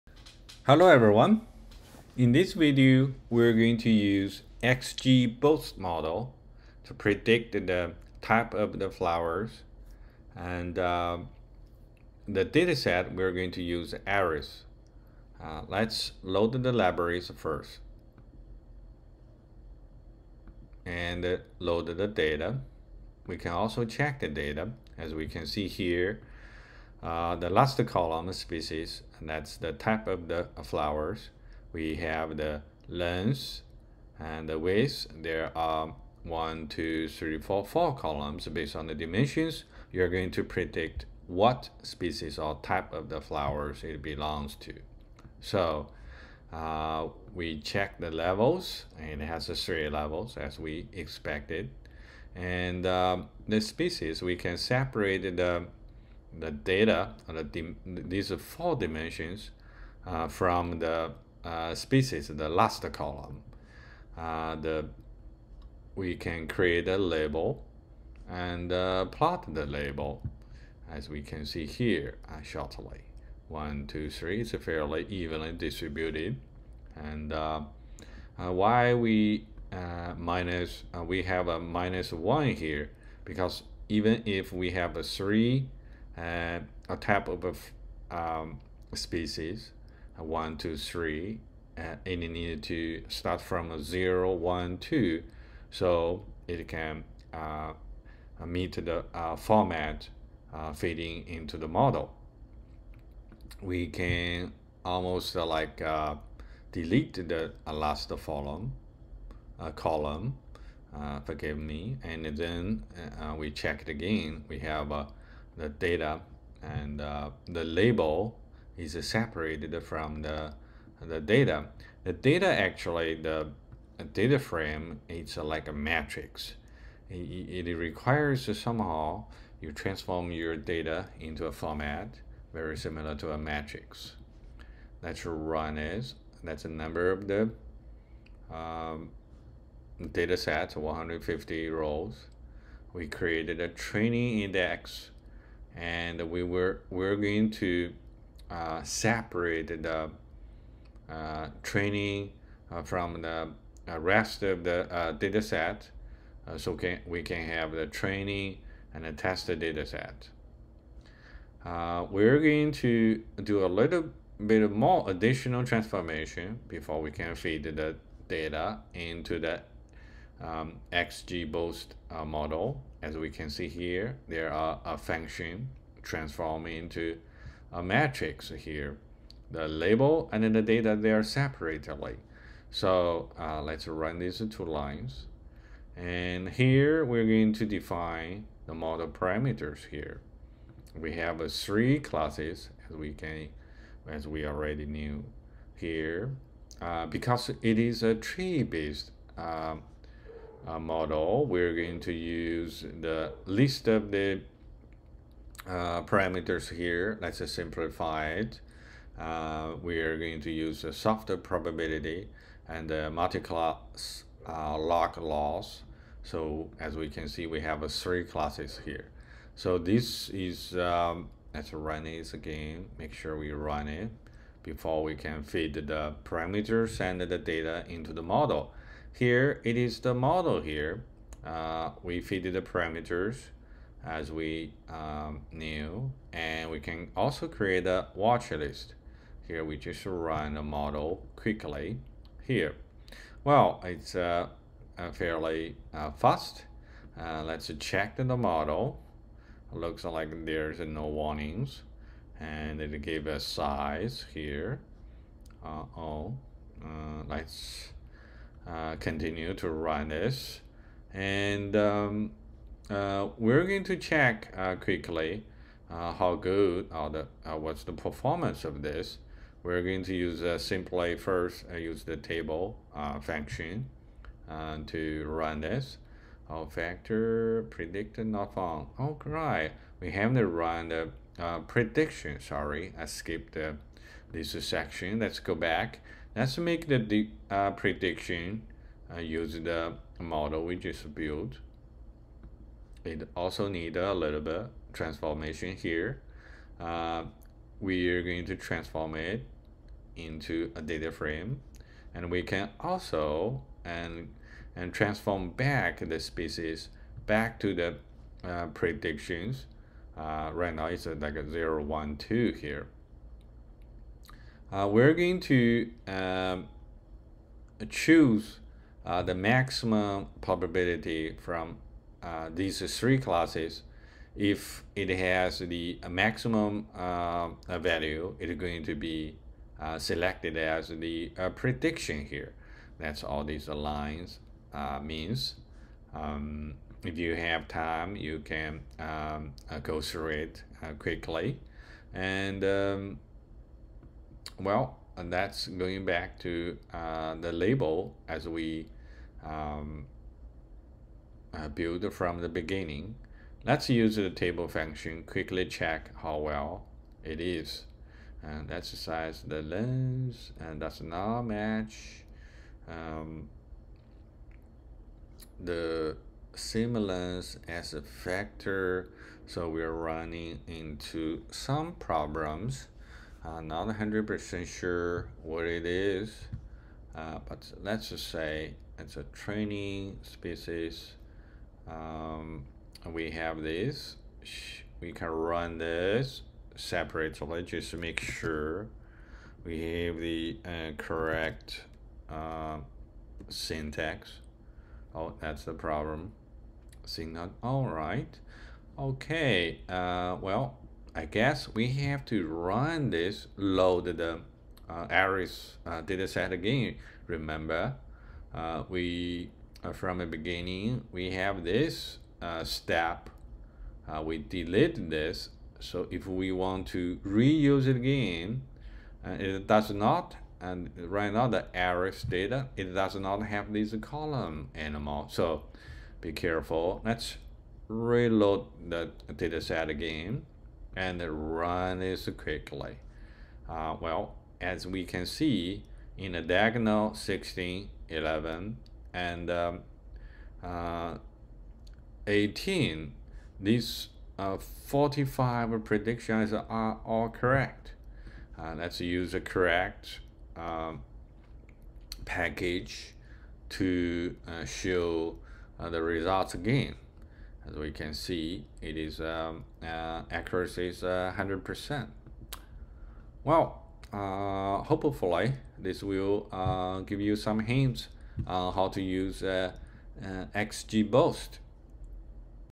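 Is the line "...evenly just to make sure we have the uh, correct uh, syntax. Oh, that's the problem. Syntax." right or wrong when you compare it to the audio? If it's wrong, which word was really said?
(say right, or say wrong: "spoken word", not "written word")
wrong: "separately", not "evenly".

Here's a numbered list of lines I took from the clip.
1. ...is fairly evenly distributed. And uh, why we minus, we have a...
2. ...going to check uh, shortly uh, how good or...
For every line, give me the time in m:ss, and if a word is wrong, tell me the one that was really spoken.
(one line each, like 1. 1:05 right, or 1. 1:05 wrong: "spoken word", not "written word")
1. 1:14 right
2. 4:23 wrong: "quickly", not "shortly".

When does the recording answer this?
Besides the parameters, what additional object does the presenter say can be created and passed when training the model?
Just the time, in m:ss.
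3:58.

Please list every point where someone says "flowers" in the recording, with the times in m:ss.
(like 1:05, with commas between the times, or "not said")
0:08, 0:30, 0:43.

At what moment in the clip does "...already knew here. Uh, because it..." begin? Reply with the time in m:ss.
3:14.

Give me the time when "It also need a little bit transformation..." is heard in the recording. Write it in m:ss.
4:53.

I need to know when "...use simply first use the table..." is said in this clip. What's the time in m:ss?
4:30.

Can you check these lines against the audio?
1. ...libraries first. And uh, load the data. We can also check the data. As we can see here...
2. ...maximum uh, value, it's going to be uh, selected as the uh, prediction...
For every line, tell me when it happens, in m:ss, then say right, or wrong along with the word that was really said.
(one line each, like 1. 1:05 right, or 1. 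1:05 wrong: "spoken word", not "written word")
1. 0:16 right
2. 5:26 right.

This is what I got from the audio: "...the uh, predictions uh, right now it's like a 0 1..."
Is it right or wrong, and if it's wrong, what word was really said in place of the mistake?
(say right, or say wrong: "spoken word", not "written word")
right.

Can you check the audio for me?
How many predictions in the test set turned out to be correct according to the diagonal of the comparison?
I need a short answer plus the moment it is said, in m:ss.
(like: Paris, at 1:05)
45, at 7:24.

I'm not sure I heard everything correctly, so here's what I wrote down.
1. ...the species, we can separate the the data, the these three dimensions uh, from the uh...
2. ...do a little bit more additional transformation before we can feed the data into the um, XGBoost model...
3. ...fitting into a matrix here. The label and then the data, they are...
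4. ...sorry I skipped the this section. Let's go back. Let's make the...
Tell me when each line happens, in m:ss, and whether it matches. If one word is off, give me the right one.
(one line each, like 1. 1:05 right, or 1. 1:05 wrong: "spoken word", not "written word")
1. 0:53 wrong: "four", not "three"
2. 2:43 right
3. 2:56 wrong: "transforming", not "fitting"
4. 4:42 right.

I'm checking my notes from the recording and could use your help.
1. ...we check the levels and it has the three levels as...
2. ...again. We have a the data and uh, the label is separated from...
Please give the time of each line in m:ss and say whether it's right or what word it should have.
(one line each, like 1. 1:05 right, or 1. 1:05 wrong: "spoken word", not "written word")
1. 0:47 right
2. 1:53 right.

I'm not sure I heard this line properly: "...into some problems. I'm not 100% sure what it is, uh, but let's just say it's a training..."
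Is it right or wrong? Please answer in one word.
right.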